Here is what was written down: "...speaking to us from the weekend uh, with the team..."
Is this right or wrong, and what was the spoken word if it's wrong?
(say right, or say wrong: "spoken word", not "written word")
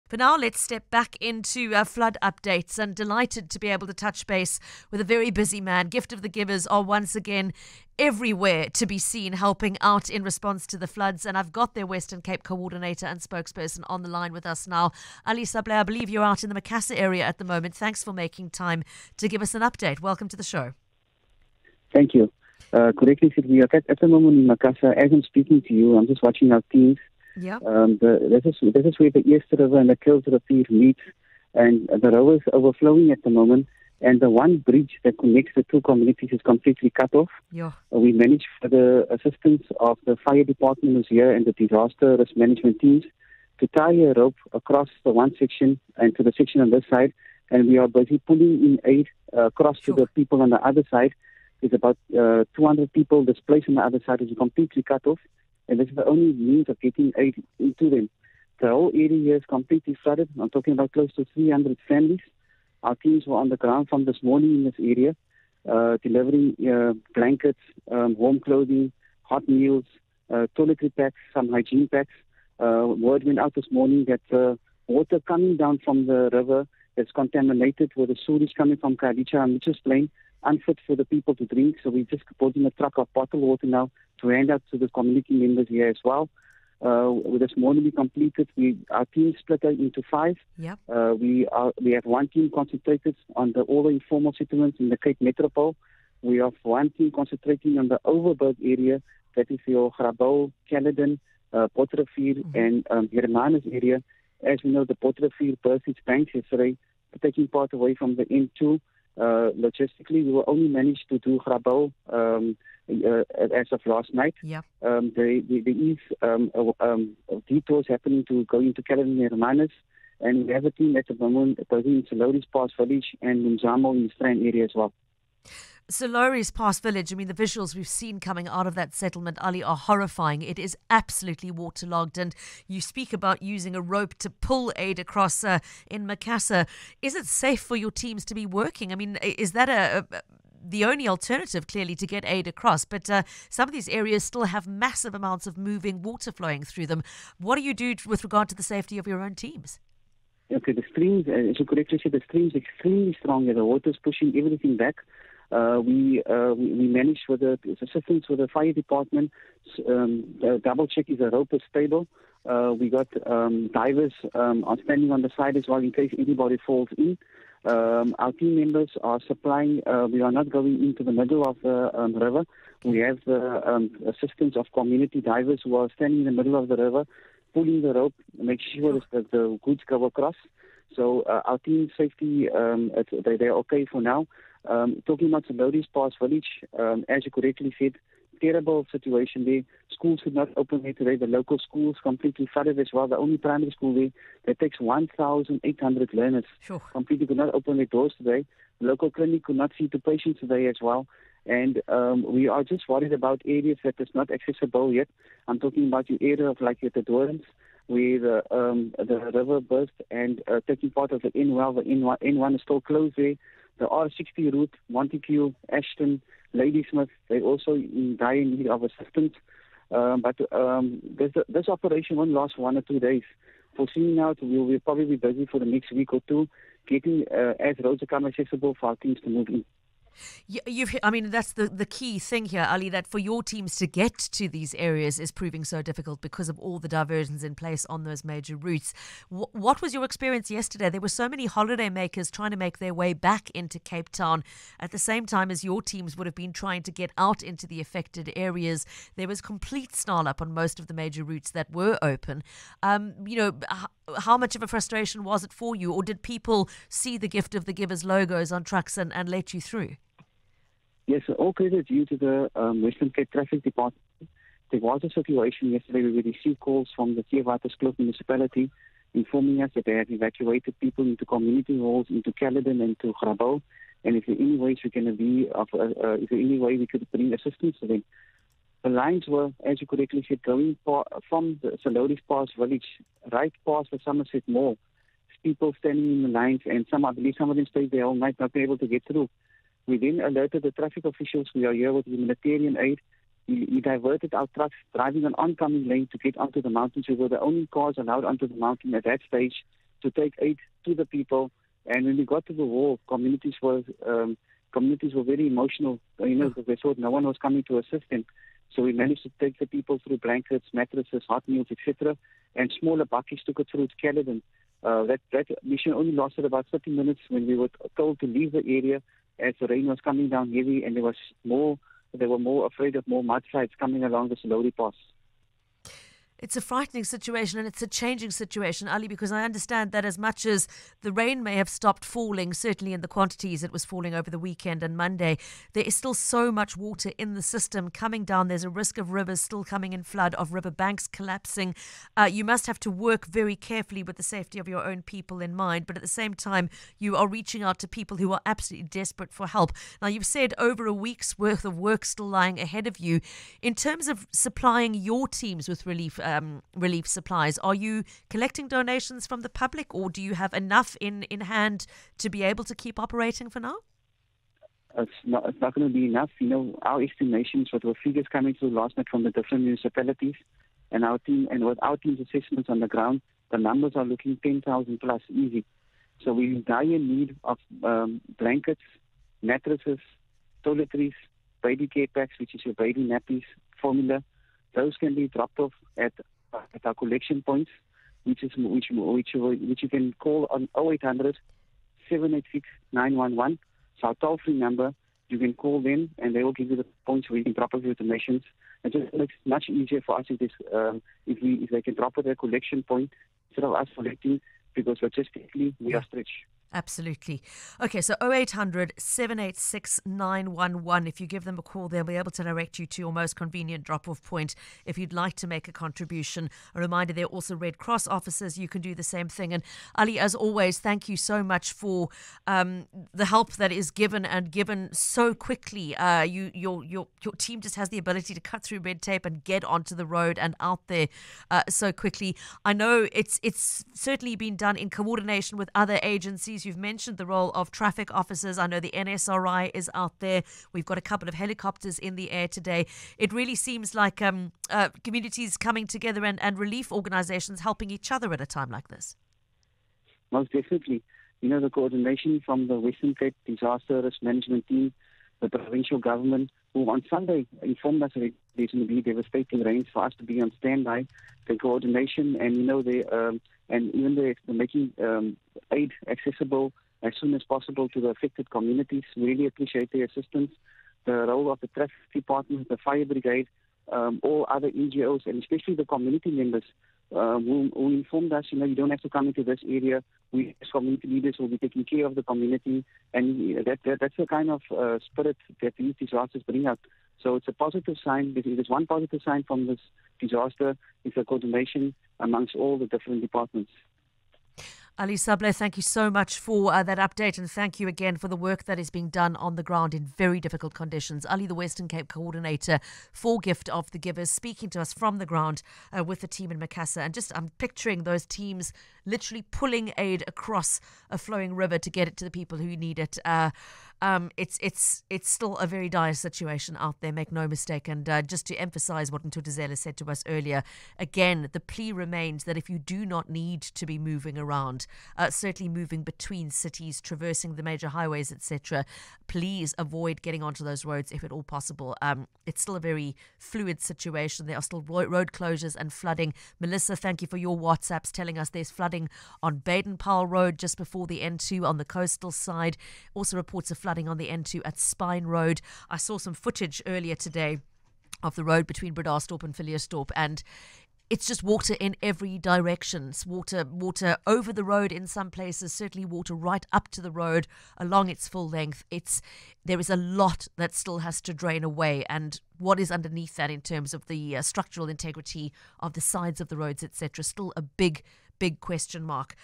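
wrong: "ground", not "weekend".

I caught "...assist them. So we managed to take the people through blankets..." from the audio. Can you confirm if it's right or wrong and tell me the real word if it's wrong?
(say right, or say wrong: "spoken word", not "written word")
right.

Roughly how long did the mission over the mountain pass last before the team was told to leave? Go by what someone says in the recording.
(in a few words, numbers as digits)
30 minutes.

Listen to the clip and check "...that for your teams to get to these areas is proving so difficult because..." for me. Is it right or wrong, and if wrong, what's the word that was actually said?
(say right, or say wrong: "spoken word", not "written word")
right.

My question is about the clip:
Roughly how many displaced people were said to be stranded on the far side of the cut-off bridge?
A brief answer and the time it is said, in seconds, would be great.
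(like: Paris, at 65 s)
200, at 52 s.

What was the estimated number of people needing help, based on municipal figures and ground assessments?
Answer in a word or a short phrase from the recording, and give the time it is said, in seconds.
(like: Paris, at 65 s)
10,000 plus, at 374 s.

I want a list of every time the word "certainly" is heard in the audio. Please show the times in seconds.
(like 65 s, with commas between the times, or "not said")
332 s, 433 s, 525 s, 555 s.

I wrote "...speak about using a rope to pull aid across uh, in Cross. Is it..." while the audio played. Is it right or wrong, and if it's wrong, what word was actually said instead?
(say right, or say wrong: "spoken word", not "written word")
wrong: "Macassar", not "Cross".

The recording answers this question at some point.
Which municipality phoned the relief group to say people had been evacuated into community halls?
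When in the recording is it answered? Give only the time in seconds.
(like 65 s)
267 s.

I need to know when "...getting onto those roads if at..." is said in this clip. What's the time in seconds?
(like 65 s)
530 s.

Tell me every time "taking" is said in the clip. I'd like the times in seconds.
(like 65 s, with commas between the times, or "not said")
107 s, 210 s, 481 s.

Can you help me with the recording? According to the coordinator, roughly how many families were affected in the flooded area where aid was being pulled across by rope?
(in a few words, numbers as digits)
300.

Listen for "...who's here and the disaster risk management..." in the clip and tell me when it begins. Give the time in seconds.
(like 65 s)
40 s.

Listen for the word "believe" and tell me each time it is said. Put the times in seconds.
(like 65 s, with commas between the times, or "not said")
15 s, 287 s.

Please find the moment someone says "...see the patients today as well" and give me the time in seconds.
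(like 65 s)
199 s.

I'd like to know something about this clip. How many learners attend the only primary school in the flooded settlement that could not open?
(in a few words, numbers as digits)
1,800.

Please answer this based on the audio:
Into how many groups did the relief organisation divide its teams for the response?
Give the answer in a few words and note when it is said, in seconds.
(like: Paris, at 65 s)
5, at 90 s.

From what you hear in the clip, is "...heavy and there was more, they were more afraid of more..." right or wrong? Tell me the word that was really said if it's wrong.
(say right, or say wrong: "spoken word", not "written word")
right.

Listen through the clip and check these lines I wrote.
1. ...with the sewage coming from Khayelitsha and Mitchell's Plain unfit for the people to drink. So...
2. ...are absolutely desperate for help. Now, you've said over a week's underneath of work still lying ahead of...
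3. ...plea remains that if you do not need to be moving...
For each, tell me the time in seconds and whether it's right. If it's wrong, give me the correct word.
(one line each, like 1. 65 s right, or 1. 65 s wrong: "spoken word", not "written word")
1. 77 s right
2. 348 s wrong: "worth", not "underneath"
3. 521 s right.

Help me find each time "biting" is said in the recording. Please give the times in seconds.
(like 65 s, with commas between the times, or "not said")
not said.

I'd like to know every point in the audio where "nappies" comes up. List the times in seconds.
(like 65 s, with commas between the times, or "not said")
383 s.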